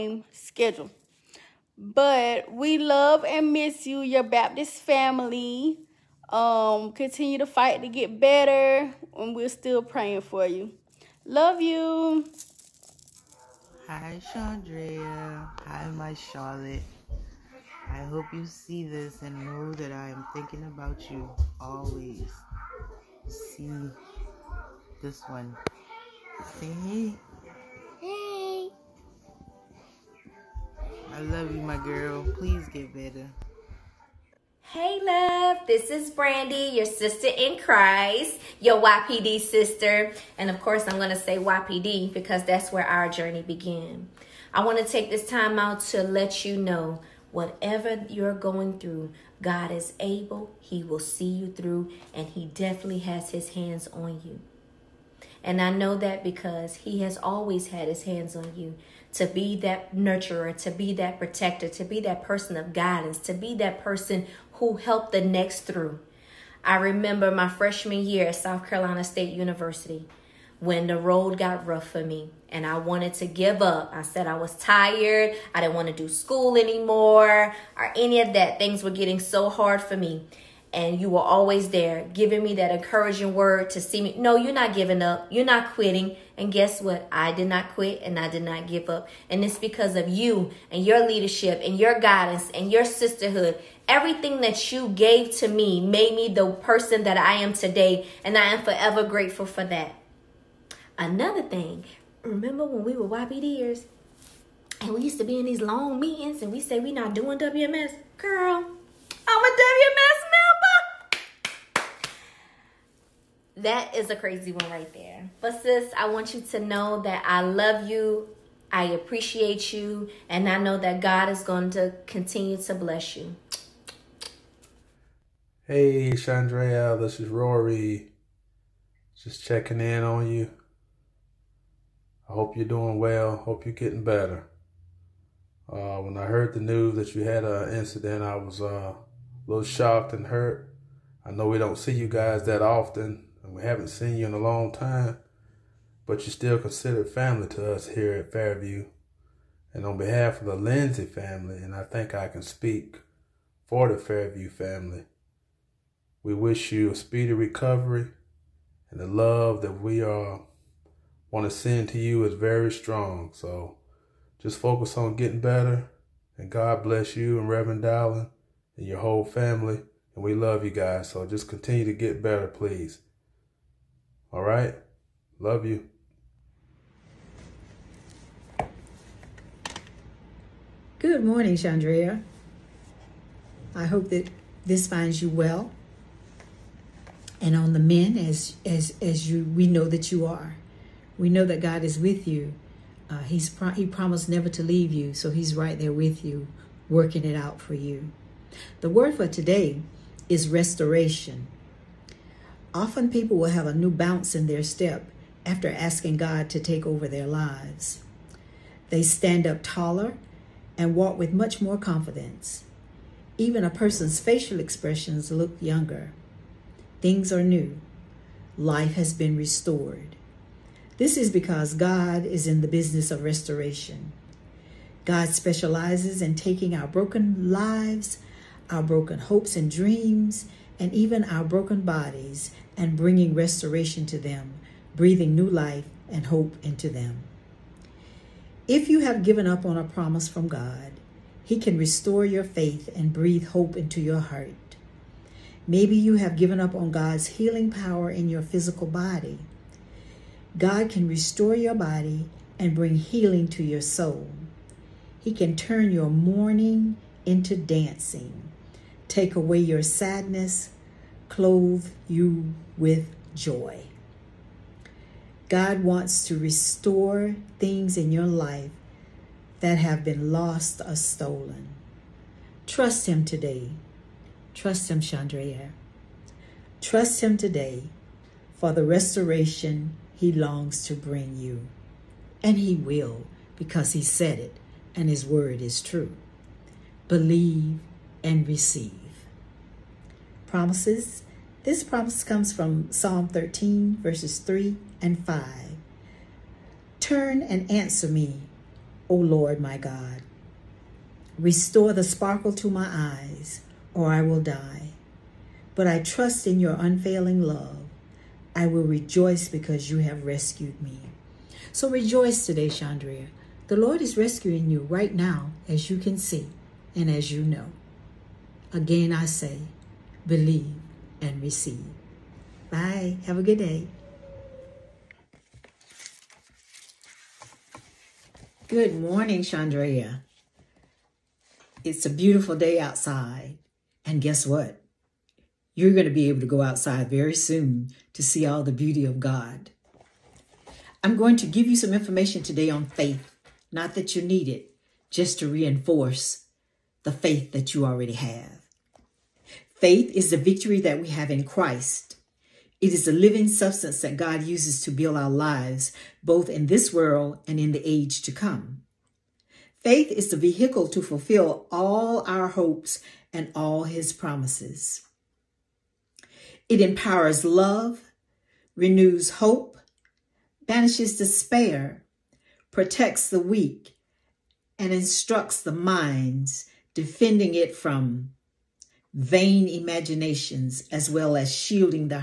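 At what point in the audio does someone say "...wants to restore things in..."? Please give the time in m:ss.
4:25.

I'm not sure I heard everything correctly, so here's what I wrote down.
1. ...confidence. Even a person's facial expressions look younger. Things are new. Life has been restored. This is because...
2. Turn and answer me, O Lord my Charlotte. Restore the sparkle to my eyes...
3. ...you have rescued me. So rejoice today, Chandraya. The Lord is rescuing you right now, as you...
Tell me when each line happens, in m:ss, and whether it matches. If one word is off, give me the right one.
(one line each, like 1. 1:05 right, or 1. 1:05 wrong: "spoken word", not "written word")
1. 3:31 right
2. 4:56 wrong: "God", not "Charlotte"
3. 5:09 wrong: "Shandrea", not "Chandraya".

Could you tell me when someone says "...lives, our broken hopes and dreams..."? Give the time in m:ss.
3:47.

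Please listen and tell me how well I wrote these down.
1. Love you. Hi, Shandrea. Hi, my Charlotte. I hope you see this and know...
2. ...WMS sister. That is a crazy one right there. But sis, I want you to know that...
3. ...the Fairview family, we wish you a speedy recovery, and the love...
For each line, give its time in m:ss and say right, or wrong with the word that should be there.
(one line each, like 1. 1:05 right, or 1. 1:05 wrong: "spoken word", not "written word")
1. 0:11 right
2. 1:49 wrong: "member", not "sister"
3. 2:33 right.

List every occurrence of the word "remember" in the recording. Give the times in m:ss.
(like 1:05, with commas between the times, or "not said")
1:06, 1:42.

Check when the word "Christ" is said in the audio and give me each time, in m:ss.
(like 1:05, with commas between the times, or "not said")
0:37, 5:51.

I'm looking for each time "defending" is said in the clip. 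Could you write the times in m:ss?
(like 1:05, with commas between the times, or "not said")
6:16.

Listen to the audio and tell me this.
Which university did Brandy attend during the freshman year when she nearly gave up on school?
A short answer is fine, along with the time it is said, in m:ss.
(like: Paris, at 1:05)
South Carolina State University, at 1:08.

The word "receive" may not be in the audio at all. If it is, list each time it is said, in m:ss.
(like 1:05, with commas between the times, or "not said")
4:48, 5:21.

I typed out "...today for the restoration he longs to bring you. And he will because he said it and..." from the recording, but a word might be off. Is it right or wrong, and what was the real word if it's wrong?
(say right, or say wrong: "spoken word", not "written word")
right.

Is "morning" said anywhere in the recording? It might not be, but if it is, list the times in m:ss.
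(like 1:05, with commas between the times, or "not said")
3:01, 5:28.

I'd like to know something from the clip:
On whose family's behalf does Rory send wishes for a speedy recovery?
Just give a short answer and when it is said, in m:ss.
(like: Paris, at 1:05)
The Lindsay family, at 2:30.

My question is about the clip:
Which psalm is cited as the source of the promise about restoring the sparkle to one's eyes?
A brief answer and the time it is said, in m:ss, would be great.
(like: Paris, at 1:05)
Psalm 13, at 4:52.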